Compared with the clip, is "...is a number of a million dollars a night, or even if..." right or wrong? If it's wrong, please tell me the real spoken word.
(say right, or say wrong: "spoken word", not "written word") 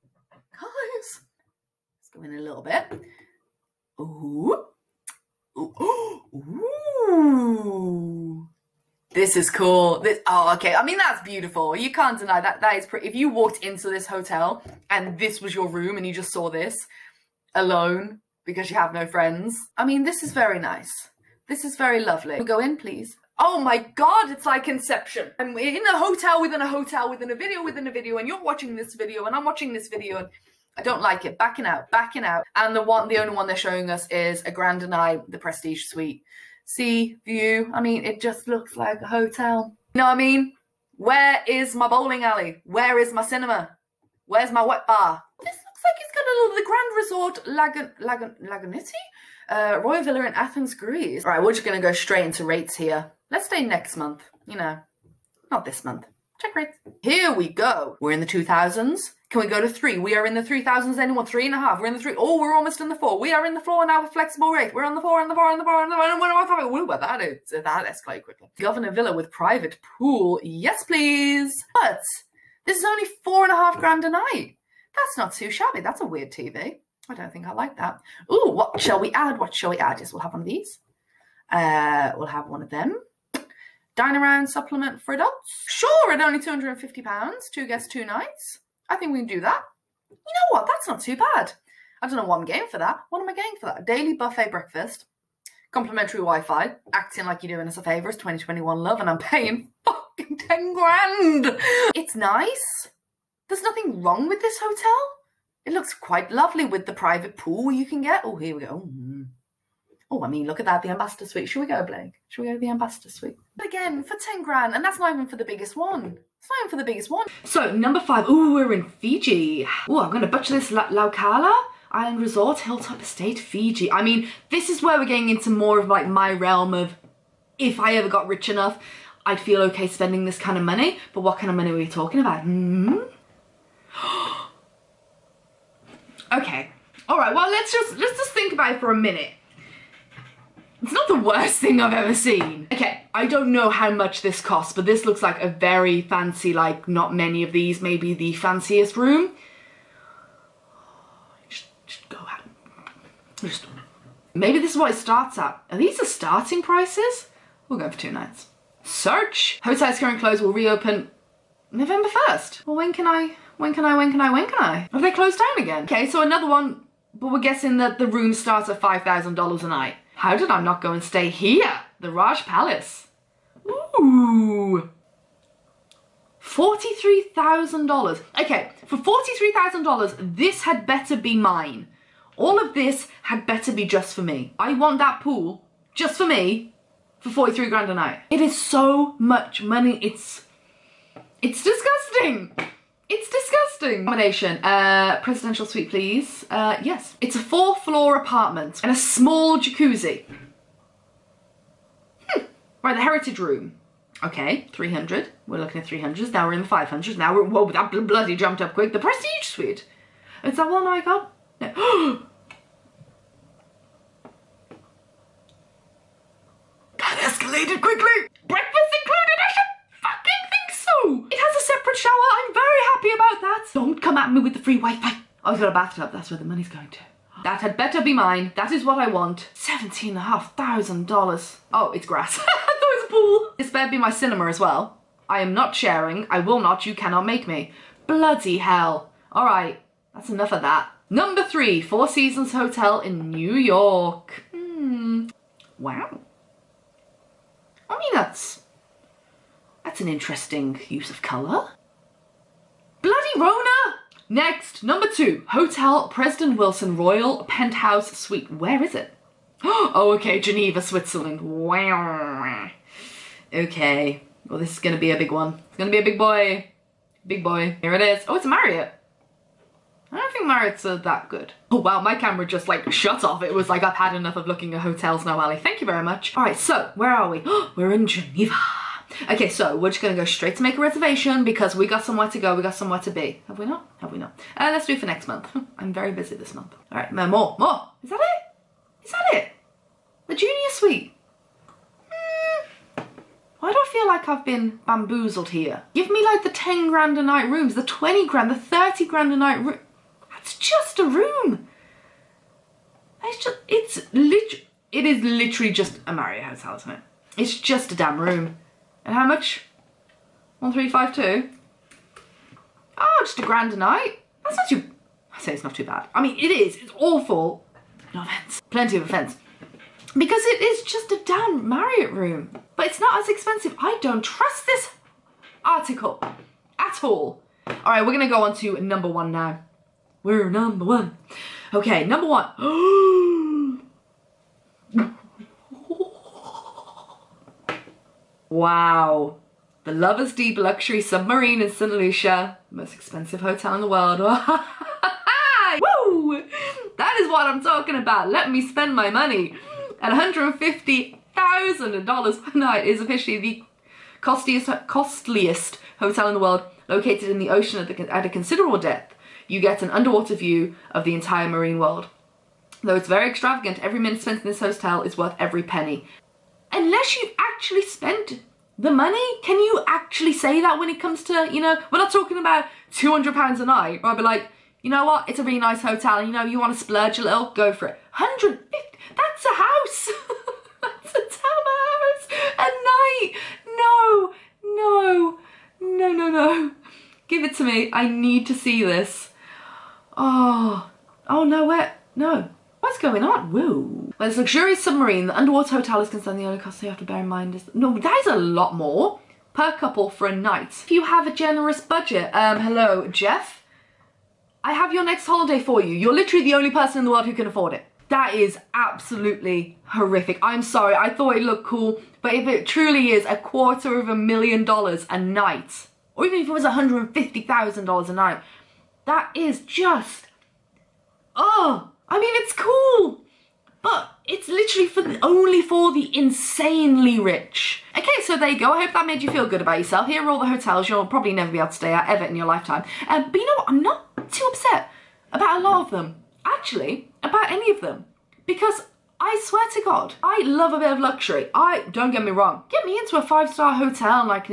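wrong: "quarter", not "number".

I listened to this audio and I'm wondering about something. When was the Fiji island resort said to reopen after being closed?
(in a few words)
November 1st.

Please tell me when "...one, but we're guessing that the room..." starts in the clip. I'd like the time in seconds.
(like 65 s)
166 s.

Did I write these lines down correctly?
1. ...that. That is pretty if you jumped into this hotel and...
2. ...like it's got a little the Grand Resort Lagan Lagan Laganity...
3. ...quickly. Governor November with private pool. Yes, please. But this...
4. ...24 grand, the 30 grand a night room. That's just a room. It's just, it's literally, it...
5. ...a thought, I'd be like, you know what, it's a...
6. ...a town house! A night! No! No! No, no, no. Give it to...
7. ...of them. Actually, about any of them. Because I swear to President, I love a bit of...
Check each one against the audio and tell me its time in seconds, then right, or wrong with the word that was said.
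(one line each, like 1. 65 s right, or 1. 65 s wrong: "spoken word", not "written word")
1. 12 s wrong: "walked", not "jumped"
2. 45 s right
3. 68 s wrong: "Villa", not "November"
4. 297 s wrong: "20", not "24"
5. 373 s wrong: "night", not "thought"
6. 381 s right
7. 435 s wrong: "God", not "President".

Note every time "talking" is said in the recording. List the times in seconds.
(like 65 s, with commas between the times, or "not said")
131 s, 347 s, 372 s.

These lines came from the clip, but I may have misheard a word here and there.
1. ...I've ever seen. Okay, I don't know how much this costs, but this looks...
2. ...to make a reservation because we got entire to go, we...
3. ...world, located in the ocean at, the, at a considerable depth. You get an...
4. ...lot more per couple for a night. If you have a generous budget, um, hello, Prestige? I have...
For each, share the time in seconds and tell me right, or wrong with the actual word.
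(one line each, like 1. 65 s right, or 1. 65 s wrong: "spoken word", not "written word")
1. 141 s right
2. 280 s wrong: "somewhere", not "entire"
3. 356 s right
4. 398 s wrong: "Jeff", not "Prestige".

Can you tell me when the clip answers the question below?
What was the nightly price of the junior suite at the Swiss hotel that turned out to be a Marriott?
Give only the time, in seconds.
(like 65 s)
310 s.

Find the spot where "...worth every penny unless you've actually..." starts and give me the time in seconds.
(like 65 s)
365 s.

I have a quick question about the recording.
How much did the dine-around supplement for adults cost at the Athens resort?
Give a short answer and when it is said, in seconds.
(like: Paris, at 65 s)
£250, at 86 s.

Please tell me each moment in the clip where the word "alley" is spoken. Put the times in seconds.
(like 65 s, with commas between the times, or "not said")
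42 s.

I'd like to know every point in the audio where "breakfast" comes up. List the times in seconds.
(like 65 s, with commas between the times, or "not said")
94 s, 218 s.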